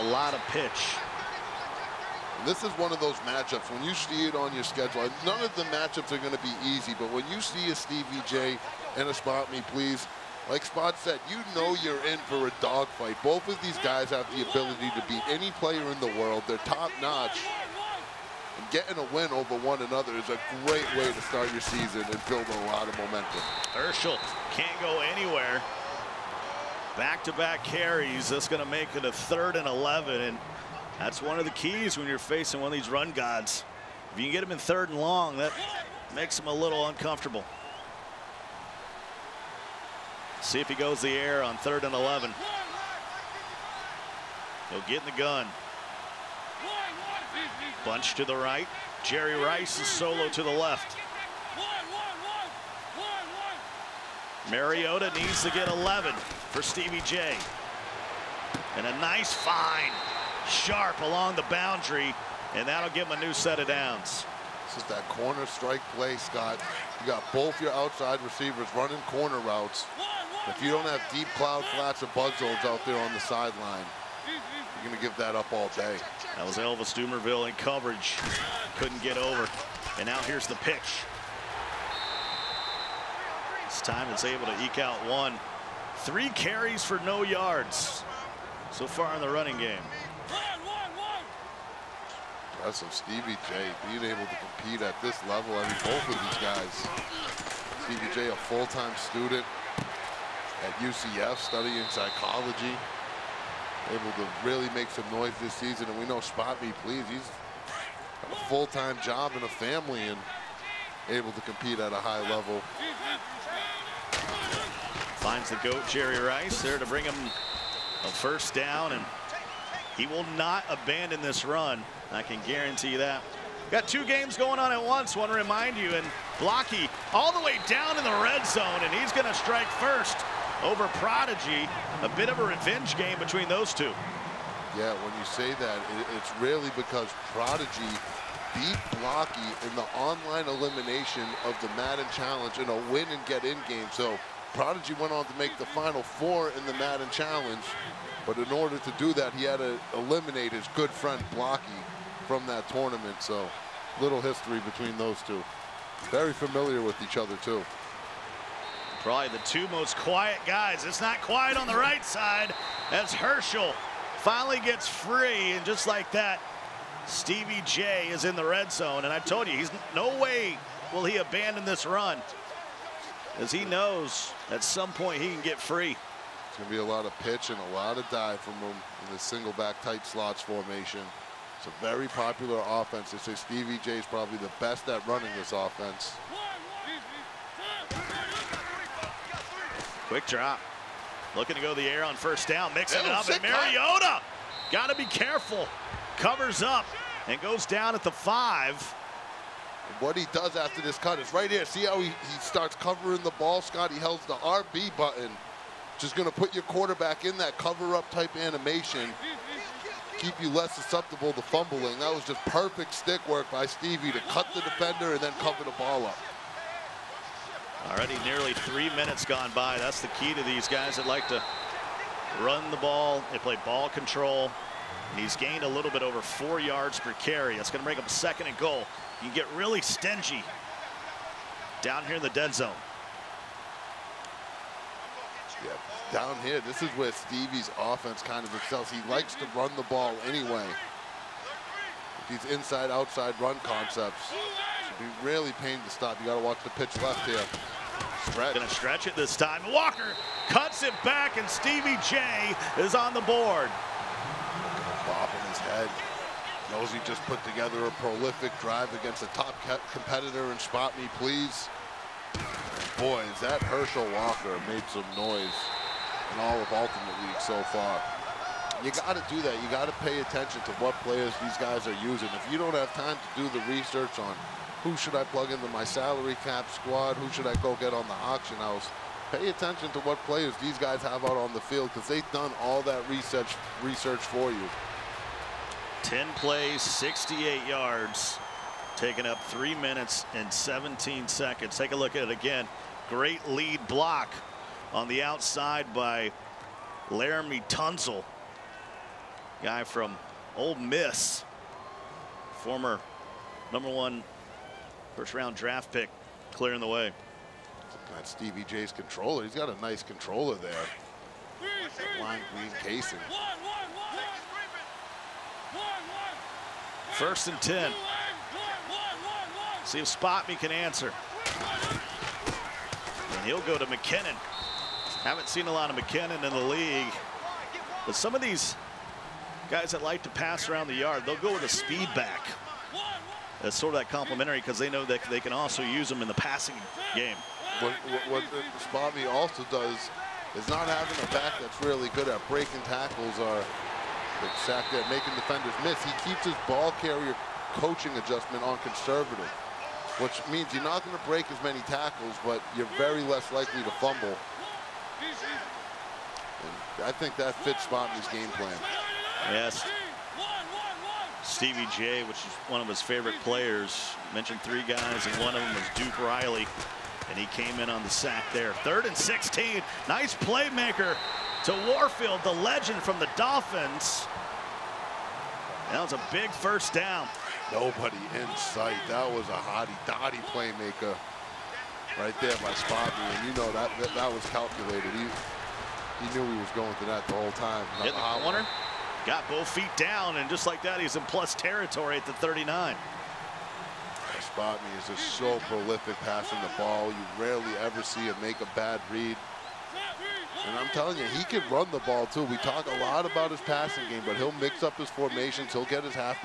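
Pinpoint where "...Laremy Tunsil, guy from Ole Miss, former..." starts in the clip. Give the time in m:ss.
4:57.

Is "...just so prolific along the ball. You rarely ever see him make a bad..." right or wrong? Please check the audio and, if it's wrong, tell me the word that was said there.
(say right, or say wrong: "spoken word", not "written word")
wrong: "passing", not "along".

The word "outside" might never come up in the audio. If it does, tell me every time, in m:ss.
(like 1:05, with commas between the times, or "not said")
1:07, 4:02, 4:55.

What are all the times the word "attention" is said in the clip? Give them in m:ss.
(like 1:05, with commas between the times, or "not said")
4:30, 4:39.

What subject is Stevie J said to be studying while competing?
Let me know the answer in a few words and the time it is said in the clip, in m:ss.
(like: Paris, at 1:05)
Psychology, at 1:41.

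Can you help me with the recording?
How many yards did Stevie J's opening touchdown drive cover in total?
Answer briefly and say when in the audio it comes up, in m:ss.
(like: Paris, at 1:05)
68, at 4:46.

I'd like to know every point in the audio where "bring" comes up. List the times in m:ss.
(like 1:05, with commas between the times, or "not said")
1:56, 3:47.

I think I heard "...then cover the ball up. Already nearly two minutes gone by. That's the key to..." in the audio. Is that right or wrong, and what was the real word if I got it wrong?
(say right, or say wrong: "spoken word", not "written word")
wrong: "three", not "two".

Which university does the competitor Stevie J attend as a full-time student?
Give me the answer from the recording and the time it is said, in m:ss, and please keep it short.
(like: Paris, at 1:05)
UCF, at 1:40.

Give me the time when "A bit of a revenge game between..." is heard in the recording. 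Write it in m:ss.
2:12.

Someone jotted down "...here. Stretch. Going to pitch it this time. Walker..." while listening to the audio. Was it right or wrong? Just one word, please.
wrong.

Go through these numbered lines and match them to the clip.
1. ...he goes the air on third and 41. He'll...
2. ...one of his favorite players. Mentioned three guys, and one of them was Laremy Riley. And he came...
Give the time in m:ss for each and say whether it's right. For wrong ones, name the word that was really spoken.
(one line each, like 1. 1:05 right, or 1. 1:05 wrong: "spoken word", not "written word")
1. 0:40 wrong: "11", not "41"
2. 6:02 wrong: "Duke", not "Laremy".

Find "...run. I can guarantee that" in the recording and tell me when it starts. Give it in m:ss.
2:01.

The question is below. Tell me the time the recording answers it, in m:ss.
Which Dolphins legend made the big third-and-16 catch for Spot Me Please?
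6:11.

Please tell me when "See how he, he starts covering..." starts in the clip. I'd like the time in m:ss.
3:21.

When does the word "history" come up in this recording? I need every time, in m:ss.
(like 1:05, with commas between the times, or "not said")
2:34.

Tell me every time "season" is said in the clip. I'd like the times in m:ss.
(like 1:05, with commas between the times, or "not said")
0:21, 1:45.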